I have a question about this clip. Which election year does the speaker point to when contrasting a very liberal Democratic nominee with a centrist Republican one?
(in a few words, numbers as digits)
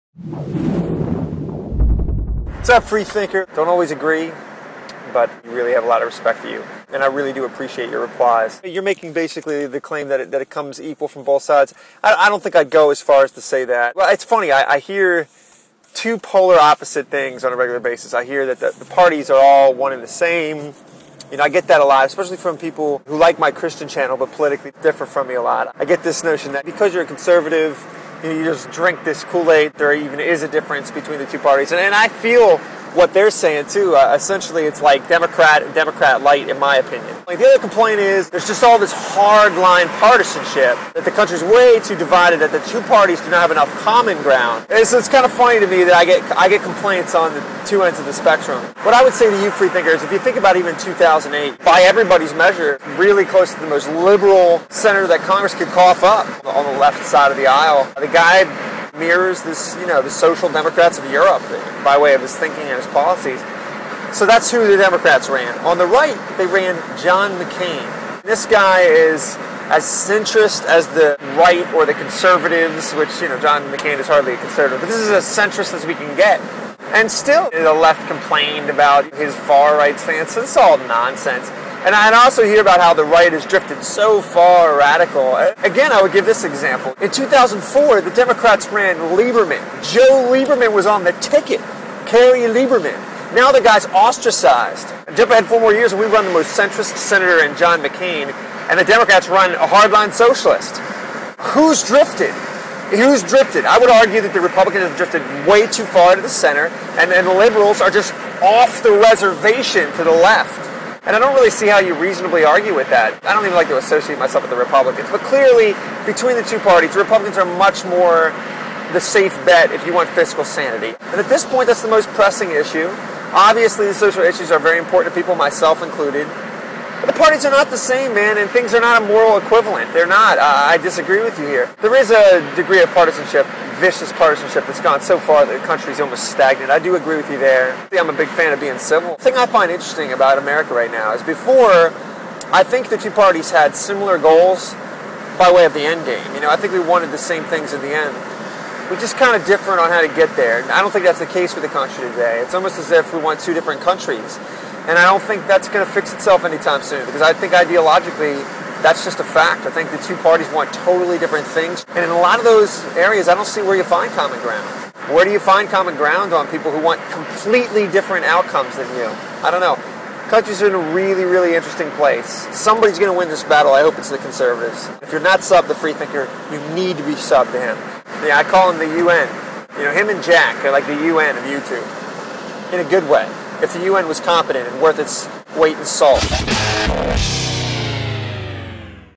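2008.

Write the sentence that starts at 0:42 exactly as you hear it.
That the two parties do not have enough common ground.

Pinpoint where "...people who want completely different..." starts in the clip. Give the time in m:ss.
2:46.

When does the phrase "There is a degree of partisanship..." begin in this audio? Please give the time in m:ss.
2:11.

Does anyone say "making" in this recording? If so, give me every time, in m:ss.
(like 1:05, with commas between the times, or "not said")
0:08.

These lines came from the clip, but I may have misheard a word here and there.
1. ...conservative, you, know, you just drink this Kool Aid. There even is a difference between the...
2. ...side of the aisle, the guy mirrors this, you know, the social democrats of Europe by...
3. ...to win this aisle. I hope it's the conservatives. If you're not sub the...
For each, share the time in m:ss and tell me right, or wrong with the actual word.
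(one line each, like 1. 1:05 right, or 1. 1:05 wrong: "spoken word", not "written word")
1. 0:27 right
2. 0:57 right
3. 2:53 wrong: "battle", not "aisle".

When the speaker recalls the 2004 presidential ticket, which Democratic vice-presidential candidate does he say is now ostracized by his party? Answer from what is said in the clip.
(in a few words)
Joe Lieberman.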